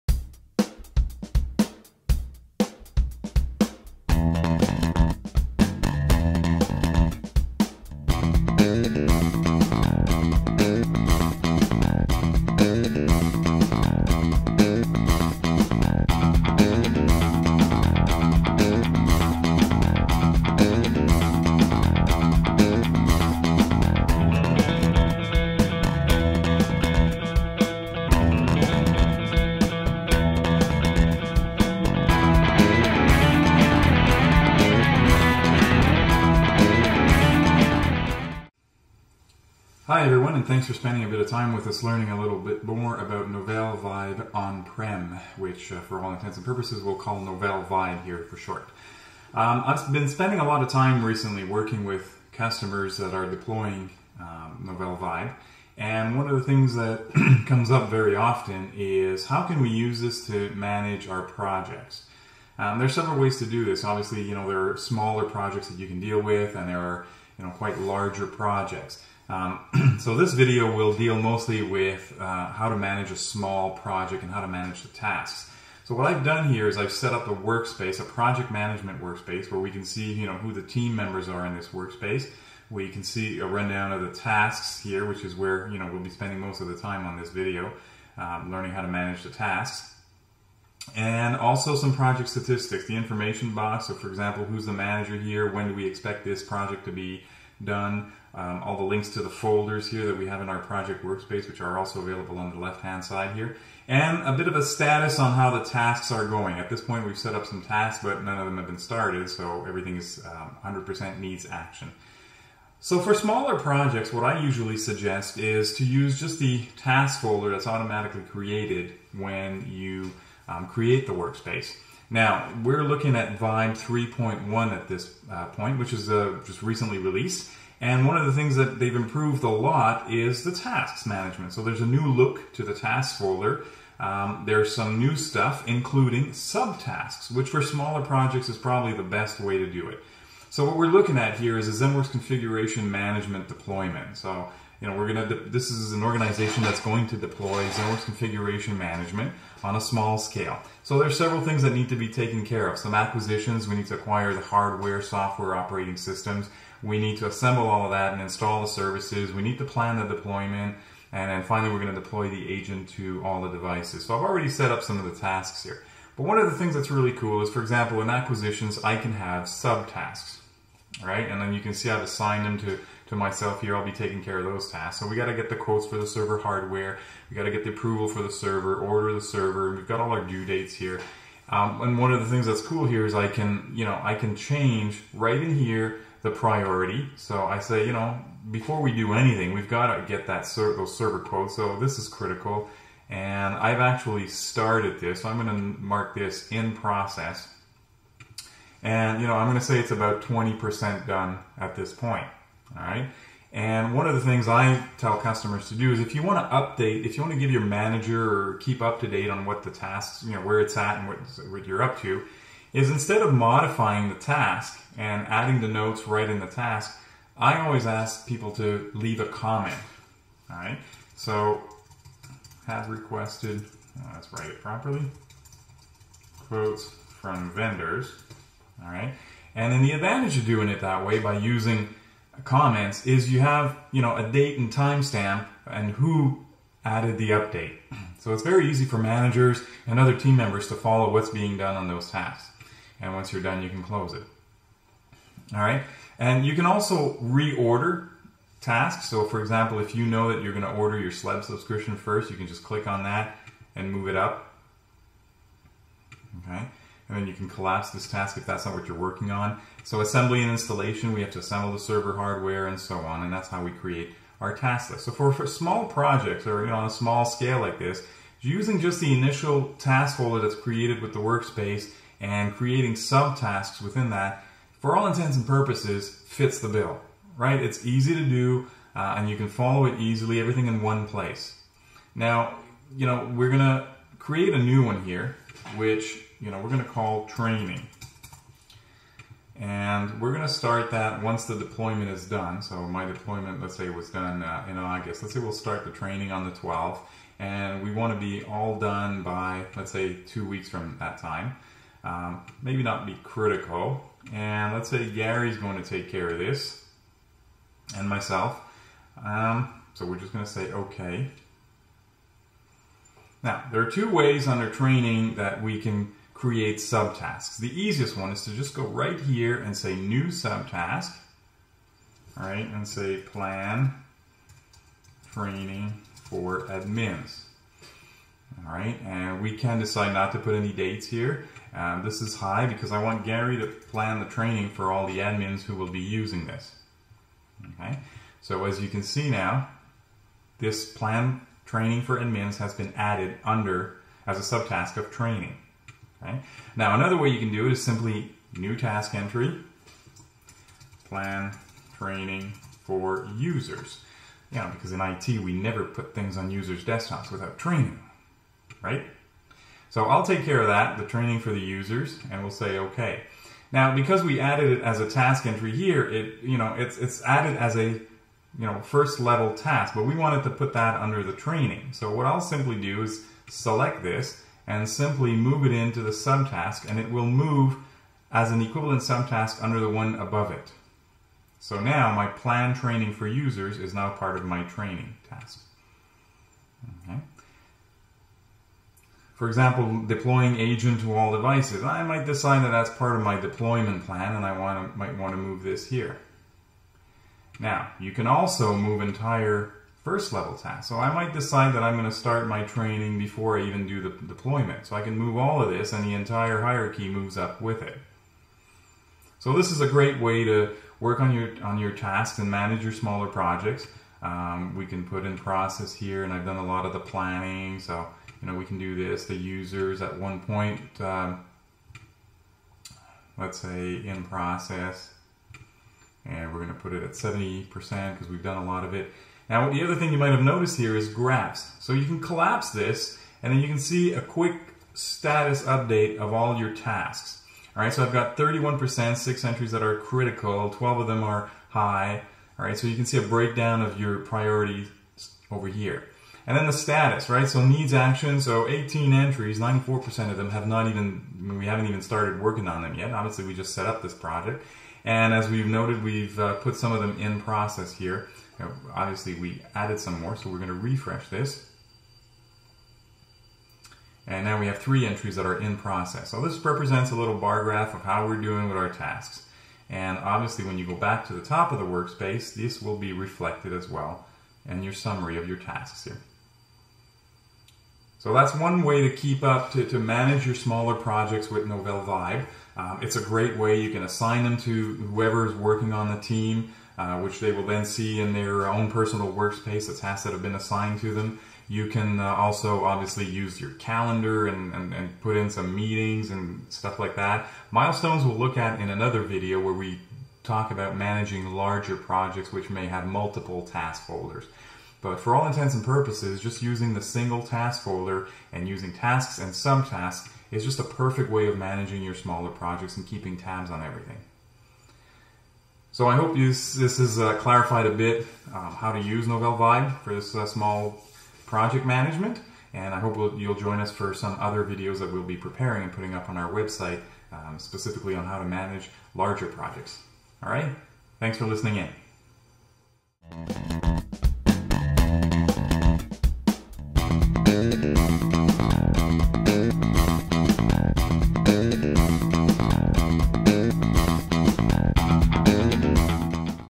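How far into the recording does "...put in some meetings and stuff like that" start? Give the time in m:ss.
8:15.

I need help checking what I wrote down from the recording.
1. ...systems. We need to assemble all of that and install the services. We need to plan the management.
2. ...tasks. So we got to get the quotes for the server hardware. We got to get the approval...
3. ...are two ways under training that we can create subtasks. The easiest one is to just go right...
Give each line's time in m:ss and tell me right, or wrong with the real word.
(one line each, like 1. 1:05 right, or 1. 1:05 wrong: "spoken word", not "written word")
1. 2:35 wrong: "deployment", not "management"
2. 2:54 right
3. 5:13 right.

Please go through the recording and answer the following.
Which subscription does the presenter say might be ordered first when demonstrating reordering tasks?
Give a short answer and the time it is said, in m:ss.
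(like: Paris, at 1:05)
SLED subscription, at 4:11.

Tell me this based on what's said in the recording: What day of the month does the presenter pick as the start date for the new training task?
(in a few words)
12th.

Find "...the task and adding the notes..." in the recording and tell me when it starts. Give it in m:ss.
3:34.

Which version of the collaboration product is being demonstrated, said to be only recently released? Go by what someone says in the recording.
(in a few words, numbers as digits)
3.1.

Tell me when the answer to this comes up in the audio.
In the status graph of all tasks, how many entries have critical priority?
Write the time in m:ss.
7:19.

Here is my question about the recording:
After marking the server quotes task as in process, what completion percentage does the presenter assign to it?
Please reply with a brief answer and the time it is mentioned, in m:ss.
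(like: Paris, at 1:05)
20%, at 3:20.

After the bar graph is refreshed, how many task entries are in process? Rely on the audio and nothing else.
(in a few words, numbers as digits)
3.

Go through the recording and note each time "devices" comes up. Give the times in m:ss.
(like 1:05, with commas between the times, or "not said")
2:43, 6:31.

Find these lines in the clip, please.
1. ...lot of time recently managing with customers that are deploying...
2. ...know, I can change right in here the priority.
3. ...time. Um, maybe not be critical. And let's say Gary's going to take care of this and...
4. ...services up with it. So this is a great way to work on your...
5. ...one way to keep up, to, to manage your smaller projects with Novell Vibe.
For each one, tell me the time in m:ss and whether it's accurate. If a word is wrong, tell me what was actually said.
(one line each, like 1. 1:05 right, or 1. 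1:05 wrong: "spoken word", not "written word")
1. 0:50 wrong: "working", not "managing"
2. 3:03 right
3. 5:01 right
4. 6:47 wrong: "moves", not "services"
5. 7:58 right.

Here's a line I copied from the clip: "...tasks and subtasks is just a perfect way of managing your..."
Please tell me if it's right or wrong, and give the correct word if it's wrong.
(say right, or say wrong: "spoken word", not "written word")
right.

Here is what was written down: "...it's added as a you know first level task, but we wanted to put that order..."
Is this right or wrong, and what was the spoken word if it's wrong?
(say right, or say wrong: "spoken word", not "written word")
wrong: "under", not "order".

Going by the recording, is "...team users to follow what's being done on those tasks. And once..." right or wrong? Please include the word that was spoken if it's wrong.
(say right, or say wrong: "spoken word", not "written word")
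wrong: "members", not "users".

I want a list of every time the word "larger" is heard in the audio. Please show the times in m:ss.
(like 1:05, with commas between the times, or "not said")
1:07, 8:21, 8:49.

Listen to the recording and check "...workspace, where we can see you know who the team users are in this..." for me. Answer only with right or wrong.
wrong.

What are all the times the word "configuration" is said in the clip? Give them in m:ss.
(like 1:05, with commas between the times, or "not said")
2:22, 2:28.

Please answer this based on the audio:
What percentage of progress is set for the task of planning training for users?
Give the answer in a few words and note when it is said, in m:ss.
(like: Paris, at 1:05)
70%, at 7:07.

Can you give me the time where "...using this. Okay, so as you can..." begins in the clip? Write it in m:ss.
5:35.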